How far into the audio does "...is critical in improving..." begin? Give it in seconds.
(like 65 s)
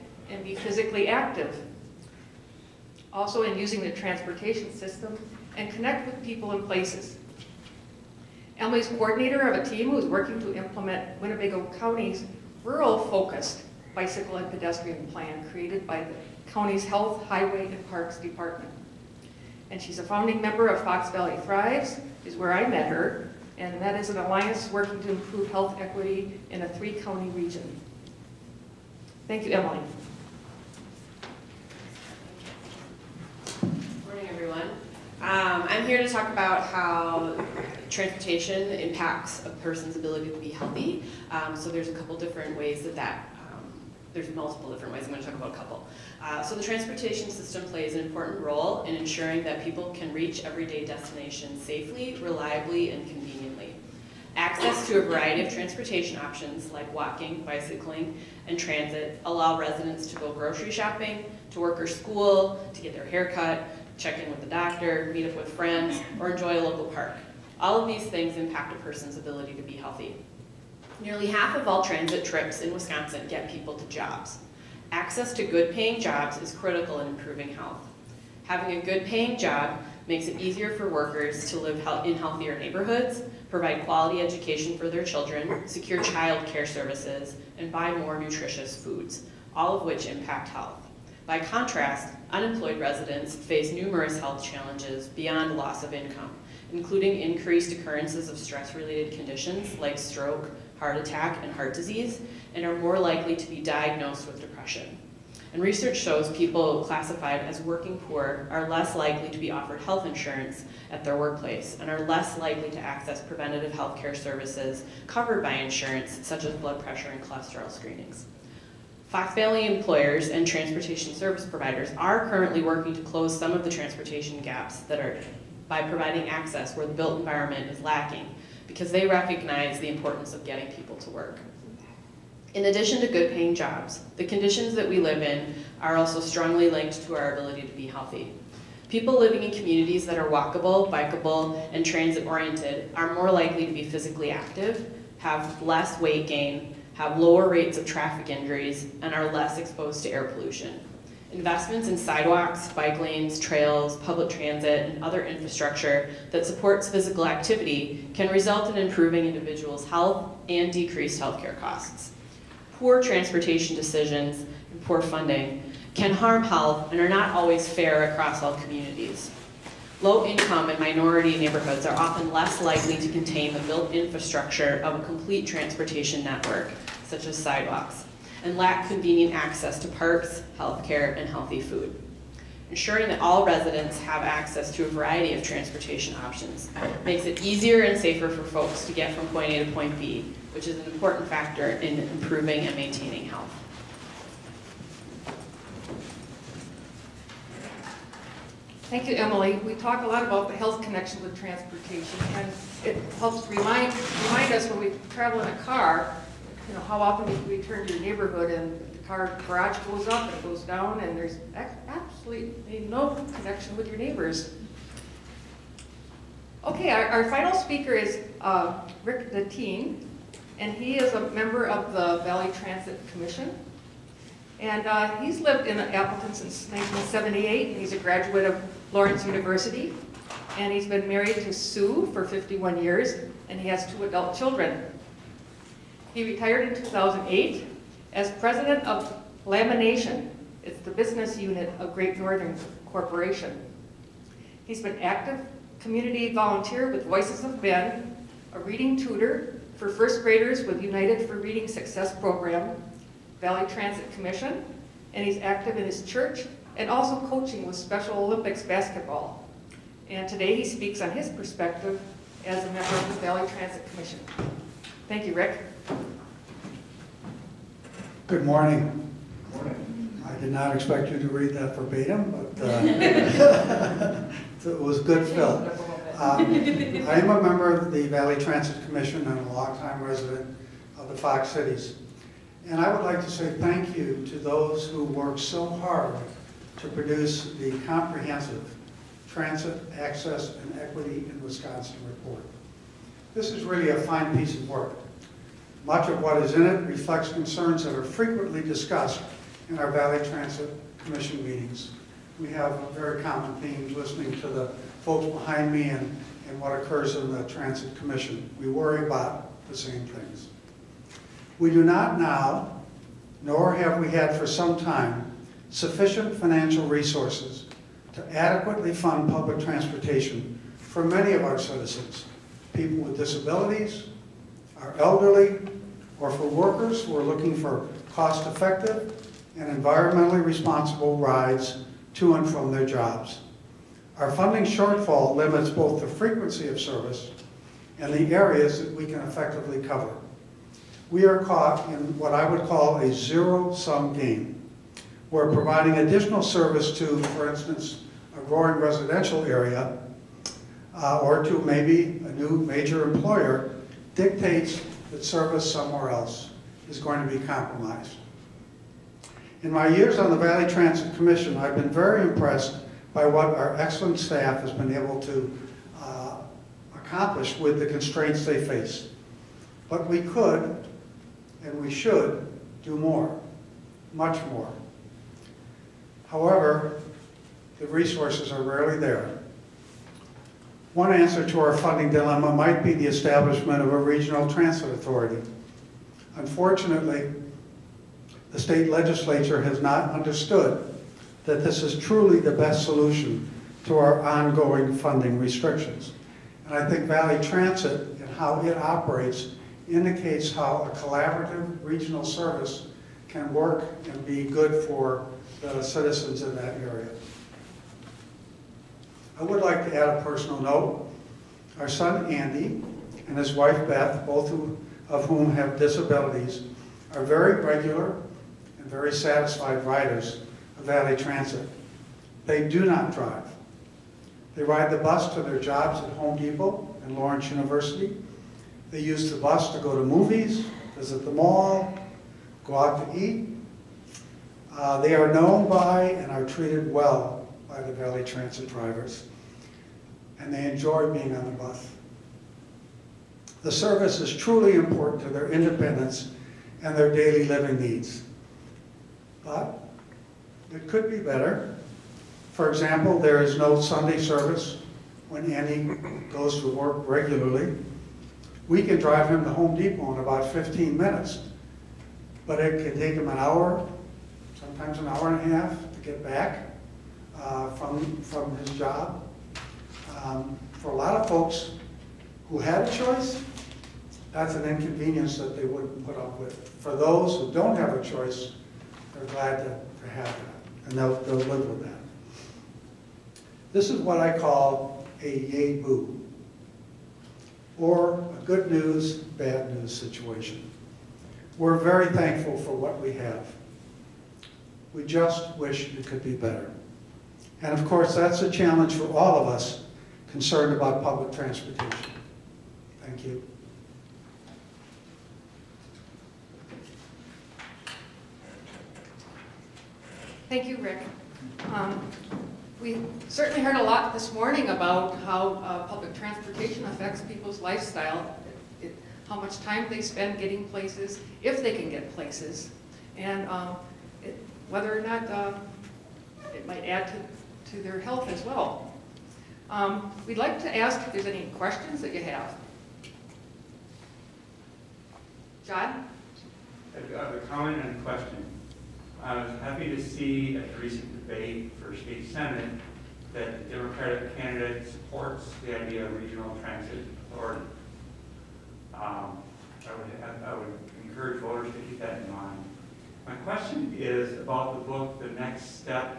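76 s.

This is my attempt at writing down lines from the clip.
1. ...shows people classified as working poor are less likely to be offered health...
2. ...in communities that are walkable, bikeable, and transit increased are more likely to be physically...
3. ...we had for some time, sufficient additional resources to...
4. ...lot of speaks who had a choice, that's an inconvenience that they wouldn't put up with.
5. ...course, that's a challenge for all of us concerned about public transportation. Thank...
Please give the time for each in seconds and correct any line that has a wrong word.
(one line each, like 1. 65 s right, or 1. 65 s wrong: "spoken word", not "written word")
1. 105 s right
2. 139 s wrong: "oriented", not "increased"
3. 314 s wrong: "financial", not "additional"
4. 470 s wrong: "folks", not "speaks"
5. 497 s right.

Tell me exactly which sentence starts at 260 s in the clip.
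And today he speaks on his perspective as a member of the Valley Transit Commission.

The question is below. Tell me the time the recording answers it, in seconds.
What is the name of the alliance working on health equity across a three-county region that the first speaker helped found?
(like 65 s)
20 s.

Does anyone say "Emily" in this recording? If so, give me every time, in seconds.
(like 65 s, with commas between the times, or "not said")
8 s, 29 s, 199 s.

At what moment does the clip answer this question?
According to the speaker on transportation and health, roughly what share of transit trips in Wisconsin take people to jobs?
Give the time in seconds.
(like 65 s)
71 s.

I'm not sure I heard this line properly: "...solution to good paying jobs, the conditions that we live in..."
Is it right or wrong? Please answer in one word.
wrong.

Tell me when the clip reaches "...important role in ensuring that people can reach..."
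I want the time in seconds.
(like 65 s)
48 s.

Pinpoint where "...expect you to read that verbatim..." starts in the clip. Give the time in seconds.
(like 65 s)
270 s.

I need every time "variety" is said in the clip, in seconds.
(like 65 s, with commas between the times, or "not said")
55 s, 184 s.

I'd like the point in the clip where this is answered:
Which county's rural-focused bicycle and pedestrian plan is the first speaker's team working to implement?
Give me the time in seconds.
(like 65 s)
11 s.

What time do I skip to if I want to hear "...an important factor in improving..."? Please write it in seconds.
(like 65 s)
190 s.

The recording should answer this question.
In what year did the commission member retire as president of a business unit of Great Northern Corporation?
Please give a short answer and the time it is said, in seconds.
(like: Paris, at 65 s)
2008, at 236 s.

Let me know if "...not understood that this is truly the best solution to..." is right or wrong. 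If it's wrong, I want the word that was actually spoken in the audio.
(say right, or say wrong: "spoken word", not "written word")
right.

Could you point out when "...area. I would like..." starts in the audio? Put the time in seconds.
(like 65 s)
406 s.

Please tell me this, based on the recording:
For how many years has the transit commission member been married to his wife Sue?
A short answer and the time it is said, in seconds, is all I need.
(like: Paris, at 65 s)
51, at 232 s.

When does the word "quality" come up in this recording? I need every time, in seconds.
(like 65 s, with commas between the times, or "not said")
83 s.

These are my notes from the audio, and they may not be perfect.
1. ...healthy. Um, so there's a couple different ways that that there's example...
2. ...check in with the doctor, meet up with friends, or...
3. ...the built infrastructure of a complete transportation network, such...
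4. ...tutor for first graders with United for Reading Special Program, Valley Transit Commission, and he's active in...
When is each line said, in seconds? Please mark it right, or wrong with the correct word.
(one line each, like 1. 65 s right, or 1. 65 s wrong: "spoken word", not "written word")
1. 40 s wrong: "multiple", not "example"
2. 63 s right
3. 173 s right
4. 248 s wrong: "Success", not "Special".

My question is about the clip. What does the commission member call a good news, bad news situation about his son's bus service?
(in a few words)
a yay boo.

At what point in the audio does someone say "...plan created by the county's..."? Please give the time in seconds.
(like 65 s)
15 s.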